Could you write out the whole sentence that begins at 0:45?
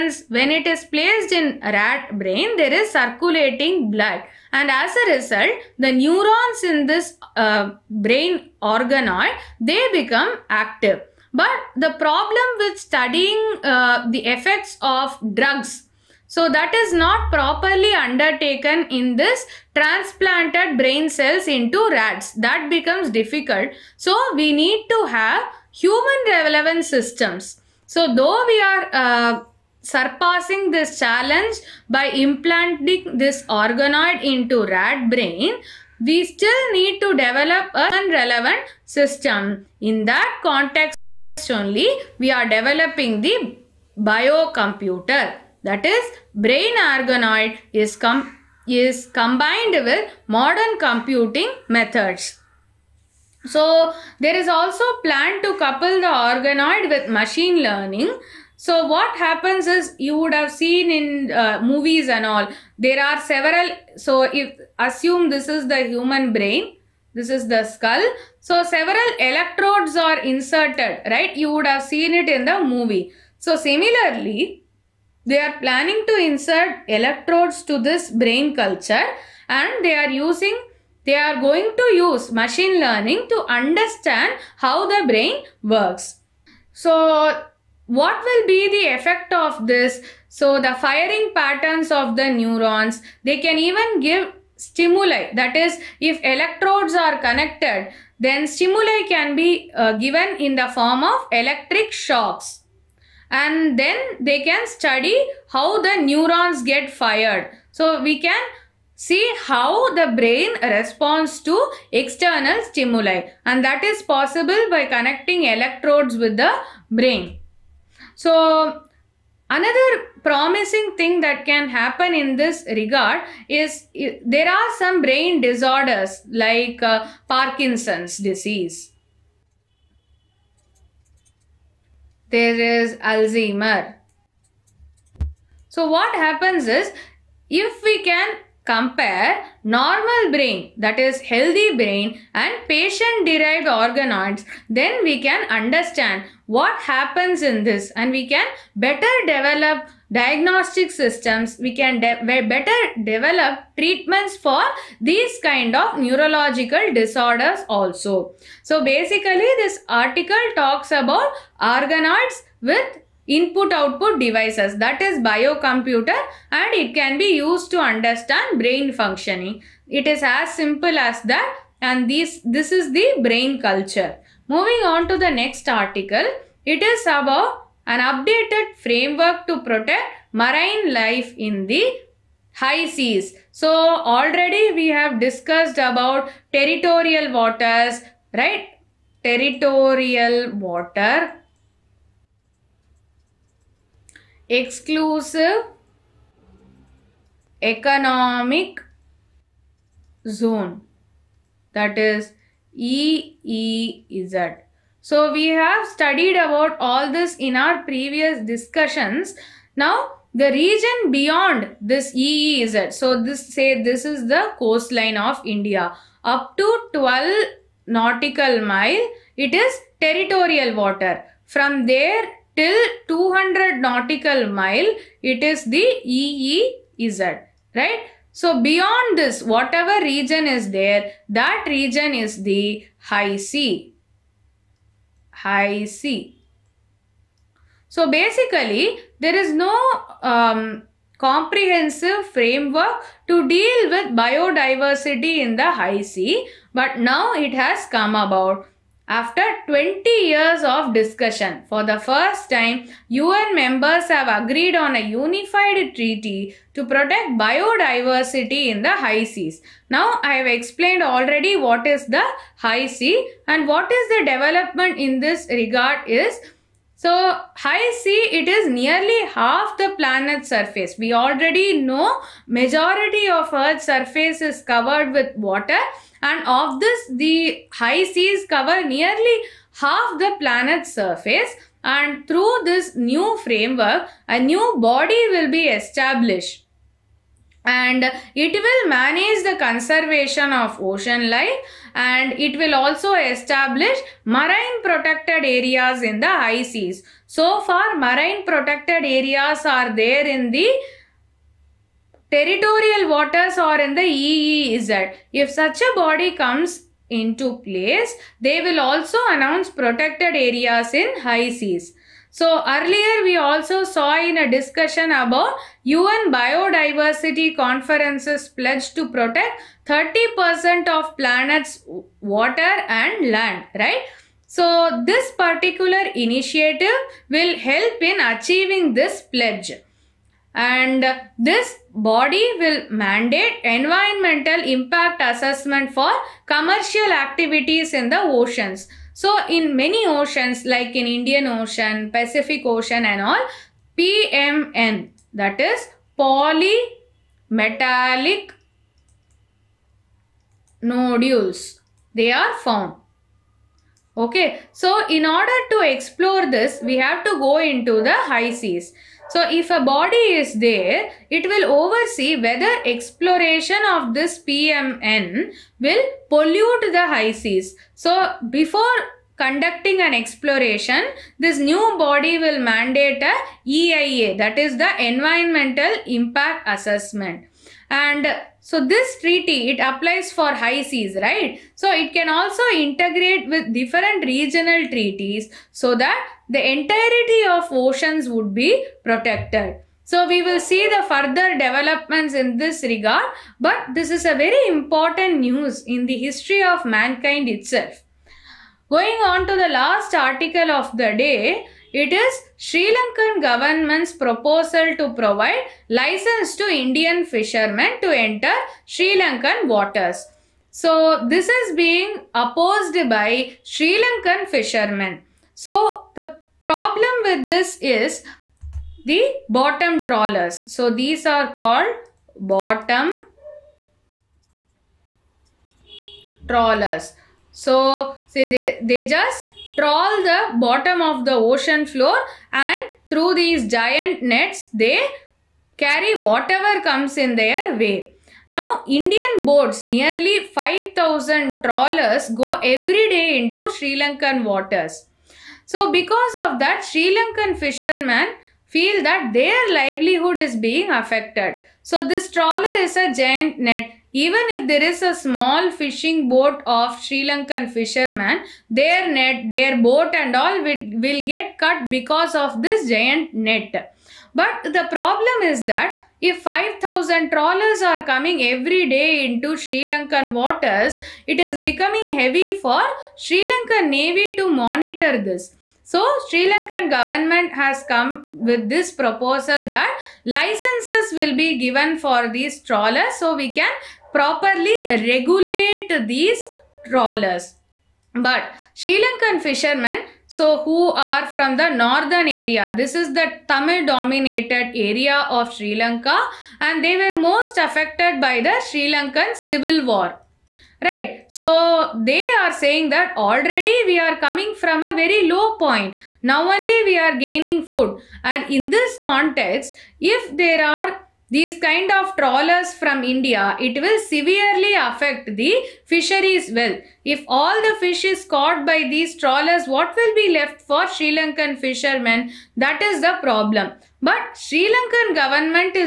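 That is, brain organoid is, com is combined with modern computing methods.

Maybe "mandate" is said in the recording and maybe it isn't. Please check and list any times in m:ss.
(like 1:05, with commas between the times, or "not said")
5:32, 6:12.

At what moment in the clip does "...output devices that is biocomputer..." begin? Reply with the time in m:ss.
2:43.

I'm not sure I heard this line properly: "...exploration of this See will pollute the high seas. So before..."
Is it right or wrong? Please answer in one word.
wrong.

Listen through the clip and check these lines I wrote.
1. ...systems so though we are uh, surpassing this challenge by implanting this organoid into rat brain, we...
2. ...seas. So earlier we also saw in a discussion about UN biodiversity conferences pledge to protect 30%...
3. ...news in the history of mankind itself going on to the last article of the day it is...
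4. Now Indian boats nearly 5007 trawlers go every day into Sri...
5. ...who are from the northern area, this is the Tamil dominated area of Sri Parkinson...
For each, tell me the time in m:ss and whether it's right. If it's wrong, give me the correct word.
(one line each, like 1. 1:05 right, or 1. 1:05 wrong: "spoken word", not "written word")
1. 0:26 right
2. 5:11 right
3. 6:35 right
4. 7:18 wrong: "5000", not "5007"
5. 8:10 wrong: "Lanka", not "Parkinson".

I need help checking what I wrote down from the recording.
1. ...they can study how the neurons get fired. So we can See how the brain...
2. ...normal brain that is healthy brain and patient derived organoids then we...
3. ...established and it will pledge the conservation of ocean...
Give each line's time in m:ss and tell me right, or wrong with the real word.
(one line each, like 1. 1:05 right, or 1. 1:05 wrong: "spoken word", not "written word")
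1. 1:44 right
2. 2:19 right
3. 4:45 wrong: "manage", not "pledge".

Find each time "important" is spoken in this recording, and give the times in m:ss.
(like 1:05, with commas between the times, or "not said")
6:34.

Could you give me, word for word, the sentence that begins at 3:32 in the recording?
So this say this is the coastline of India.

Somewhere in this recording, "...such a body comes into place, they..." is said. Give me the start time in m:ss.
5:05.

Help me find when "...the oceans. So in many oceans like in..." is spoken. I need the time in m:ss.
5:38.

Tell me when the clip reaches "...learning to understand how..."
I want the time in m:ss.
1:22.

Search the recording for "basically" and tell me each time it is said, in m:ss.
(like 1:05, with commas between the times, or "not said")
2:38, 3:58.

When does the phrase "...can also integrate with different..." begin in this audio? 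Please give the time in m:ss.
6:22.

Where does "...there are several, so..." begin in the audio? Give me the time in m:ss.
1:02.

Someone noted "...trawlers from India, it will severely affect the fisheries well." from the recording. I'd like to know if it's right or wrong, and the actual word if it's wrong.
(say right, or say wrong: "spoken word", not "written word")
right.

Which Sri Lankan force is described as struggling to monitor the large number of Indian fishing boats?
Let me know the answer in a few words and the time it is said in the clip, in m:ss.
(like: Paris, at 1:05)
Sri Lankan Navy, at 7:53.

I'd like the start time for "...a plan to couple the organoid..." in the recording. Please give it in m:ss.
0:54.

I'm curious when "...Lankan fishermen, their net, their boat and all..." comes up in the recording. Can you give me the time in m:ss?
7:37.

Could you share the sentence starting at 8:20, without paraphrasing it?
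Right, so they are saying that already we are coming from a very low point.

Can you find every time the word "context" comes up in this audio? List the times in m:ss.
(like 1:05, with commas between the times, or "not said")
0:40, 8:29.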